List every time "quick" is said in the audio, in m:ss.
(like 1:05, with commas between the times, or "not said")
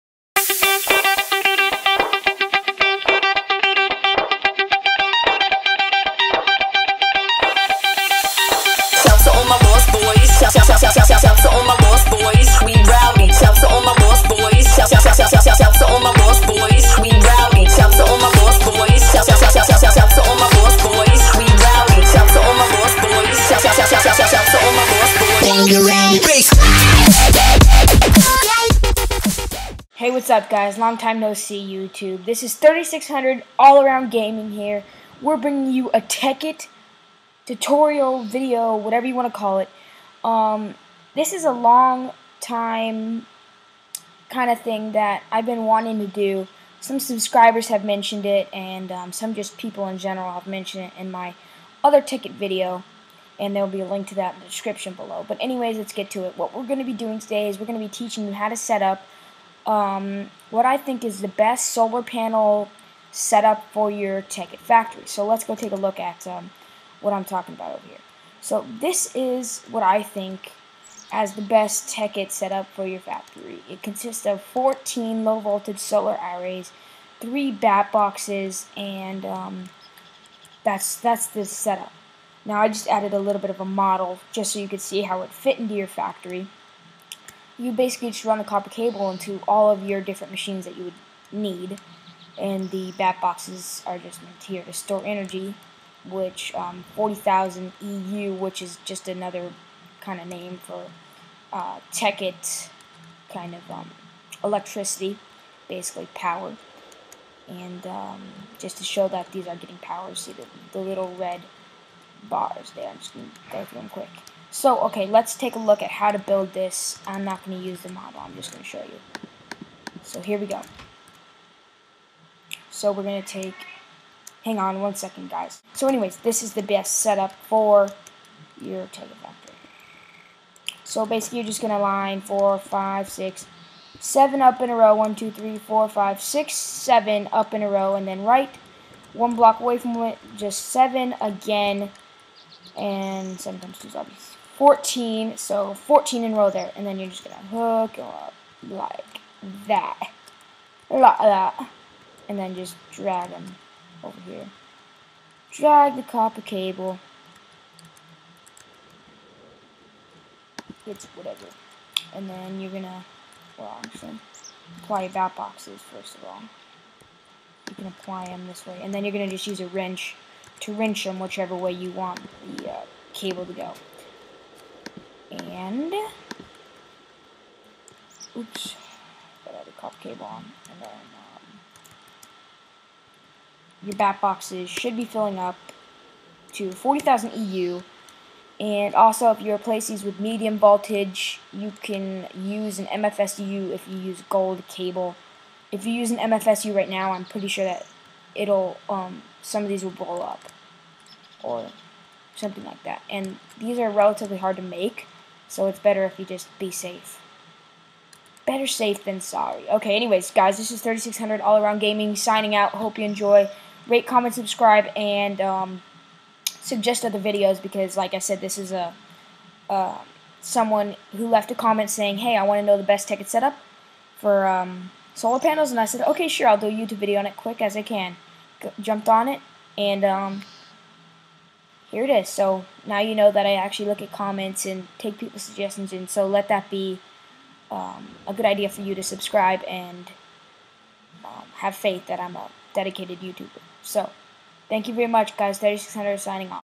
1:53, 3:47.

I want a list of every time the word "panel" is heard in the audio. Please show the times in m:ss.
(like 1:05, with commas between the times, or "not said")
1:02, 3:45.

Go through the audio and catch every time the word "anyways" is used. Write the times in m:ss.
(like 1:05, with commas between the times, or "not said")
0:55, 2:05, 3:29.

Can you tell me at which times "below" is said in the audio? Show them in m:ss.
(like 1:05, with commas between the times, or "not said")
0:54.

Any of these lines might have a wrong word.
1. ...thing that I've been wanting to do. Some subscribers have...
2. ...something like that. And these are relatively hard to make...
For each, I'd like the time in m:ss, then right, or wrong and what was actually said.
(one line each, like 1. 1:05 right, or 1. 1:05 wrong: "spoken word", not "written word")
1. 0:44 right
2. 3:22 right.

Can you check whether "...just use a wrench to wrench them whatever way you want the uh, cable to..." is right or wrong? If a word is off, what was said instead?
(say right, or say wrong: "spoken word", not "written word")
wrong: "whichever", not "whatever".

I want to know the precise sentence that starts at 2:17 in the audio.
And then right, one block away from it, just seven again.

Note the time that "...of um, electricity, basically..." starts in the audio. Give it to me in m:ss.
1:43.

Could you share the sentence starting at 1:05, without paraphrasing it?
So let's go take a look at um, what I'm talking about over here.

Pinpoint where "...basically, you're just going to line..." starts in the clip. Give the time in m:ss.
2:11.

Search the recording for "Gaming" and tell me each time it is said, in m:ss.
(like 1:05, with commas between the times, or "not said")
0:34, 3:31.